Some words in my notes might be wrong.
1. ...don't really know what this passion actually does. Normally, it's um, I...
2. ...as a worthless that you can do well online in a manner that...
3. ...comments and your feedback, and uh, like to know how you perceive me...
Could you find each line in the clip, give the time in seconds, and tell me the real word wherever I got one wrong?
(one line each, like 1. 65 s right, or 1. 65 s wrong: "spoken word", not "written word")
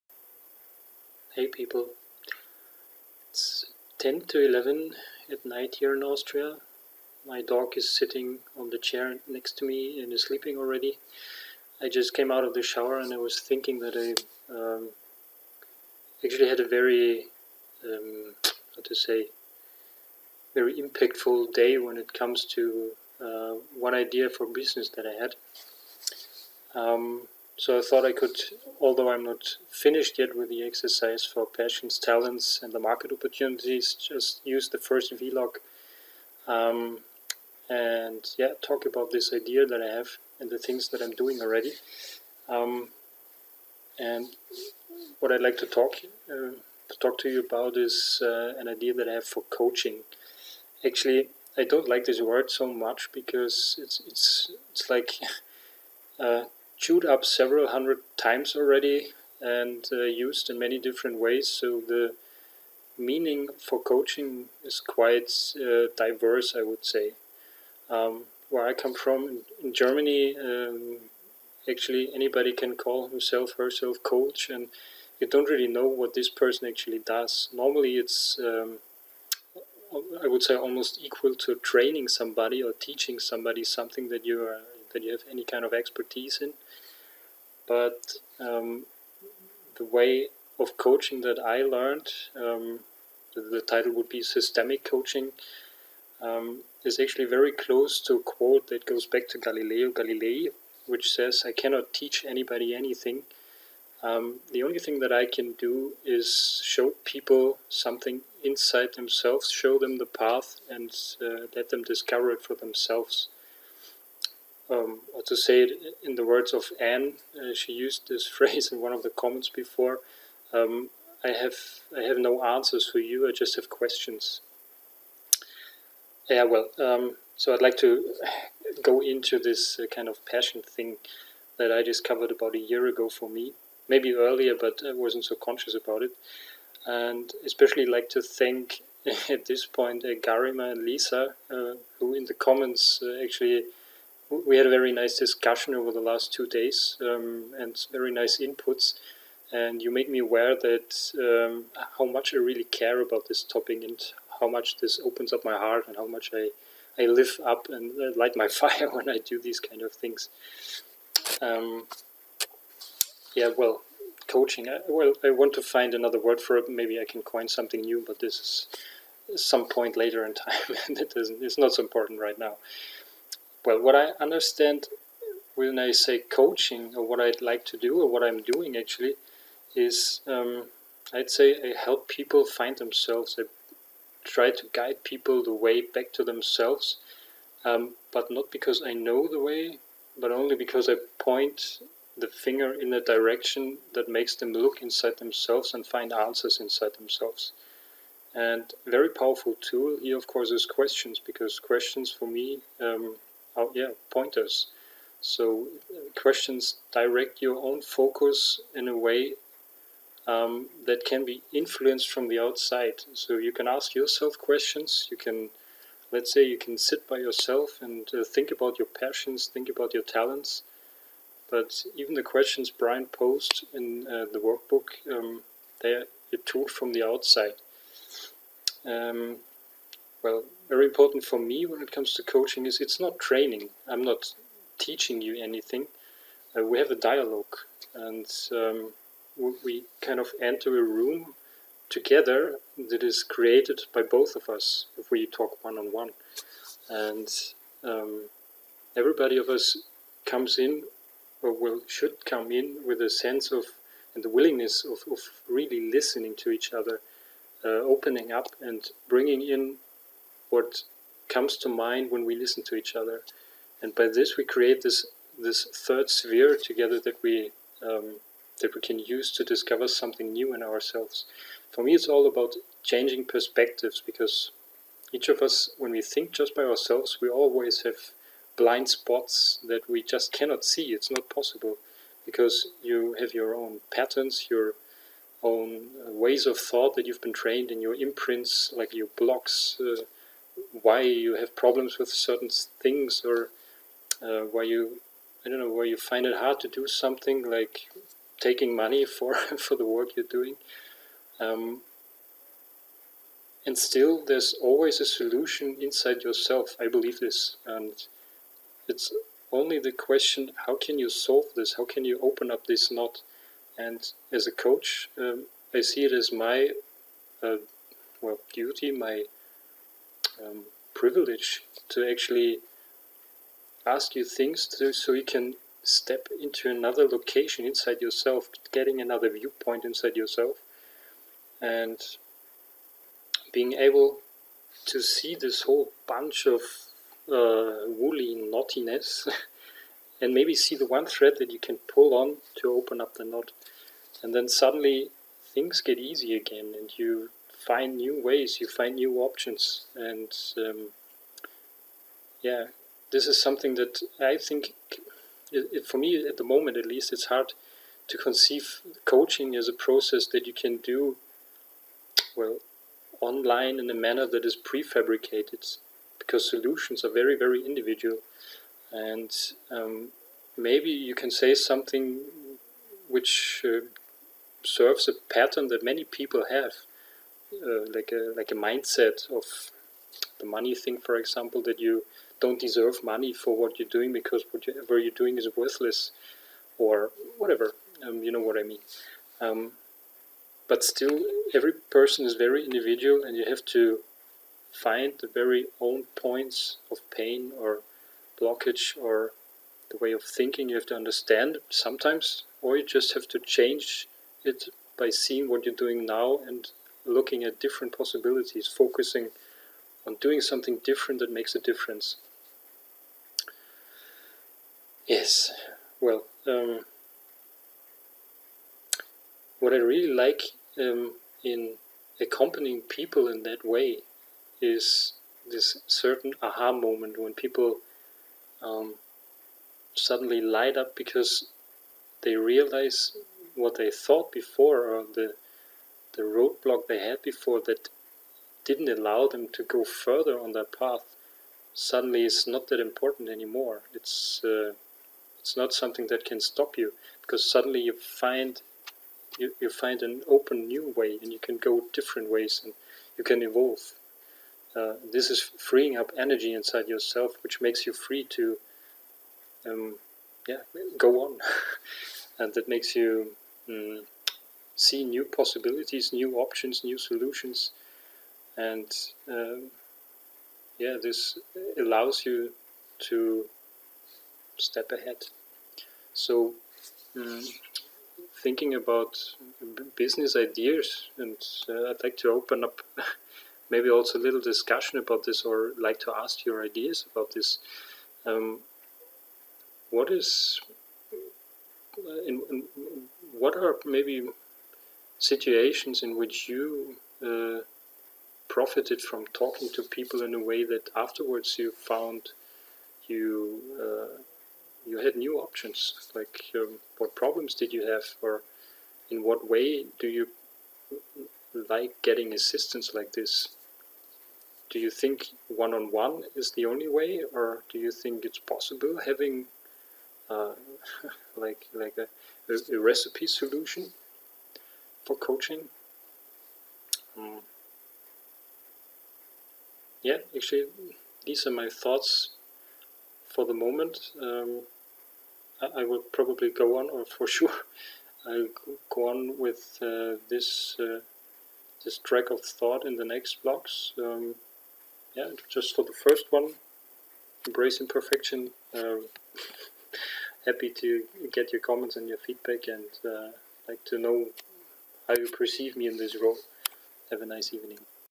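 1. 75 s wrong: "person", not "passion"
2. 359 s wrong: "process", not "worthless"
3. 551 s right.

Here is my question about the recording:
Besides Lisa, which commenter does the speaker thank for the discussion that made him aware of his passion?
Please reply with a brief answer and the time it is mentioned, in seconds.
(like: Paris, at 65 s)
Garima, at 140 s.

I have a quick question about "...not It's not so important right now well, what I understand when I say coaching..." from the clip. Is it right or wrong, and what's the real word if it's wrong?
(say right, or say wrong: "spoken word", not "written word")
right.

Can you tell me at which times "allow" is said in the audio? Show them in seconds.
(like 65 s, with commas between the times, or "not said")
438 s, 471 s.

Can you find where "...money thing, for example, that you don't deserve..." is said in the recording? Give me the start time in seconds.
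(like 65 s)
380 s.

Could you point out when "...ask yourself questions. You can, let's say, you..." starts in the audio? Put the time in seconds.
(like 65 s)
213 s.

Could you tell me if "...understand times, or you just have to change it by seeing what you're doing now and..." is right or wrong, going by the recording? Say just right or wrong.
wrong.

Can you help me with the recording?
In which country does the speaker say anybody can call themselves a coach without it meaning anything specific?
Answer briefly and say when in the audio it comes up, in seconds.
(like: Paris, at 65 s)
Germany, at 69 s.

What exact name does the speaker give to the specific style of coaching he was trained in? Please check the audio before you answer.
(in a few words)
systemic coaching.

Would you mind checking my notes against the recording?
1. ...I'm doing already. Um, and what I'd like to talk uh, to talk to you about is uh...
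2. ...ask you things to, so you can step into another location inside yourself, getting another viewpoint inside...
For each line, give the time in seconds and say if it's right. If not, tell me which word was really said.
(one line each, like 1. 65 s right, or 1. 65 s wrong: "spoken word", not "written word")
1. 41 s right
2. 323 s right.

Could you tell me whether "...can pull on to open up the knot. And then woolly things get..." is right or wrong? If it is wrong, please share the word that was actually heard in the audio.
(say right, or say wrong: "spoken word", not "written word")
wrong: "suddenly", not "woolly".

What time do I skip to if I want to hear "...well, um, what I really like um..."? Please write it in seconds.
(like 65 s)
415 s.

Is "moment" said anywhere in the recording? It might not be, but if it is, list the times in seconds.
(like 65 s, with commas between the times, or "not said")
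356 s, 426 s, 533 s.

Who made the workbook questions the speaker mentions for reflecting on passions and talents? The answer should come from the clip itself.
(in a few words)
Brian.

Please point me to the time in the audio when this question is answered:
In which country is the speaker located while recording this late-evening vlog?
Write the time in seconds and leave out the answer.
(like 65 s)
6 s.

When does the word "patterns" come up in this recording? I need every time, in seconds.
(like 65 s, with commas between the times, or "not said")
283 s, 375 s.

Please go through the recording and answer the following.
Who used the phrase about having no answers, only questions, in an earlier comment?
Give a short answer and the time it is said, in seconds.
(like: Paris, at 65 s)
Anne, at 116 s.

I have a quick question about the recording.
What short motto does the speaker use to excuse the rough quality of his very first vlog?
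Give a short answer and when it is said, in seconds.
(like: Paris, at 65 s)
embrace imperfection, at 547 s.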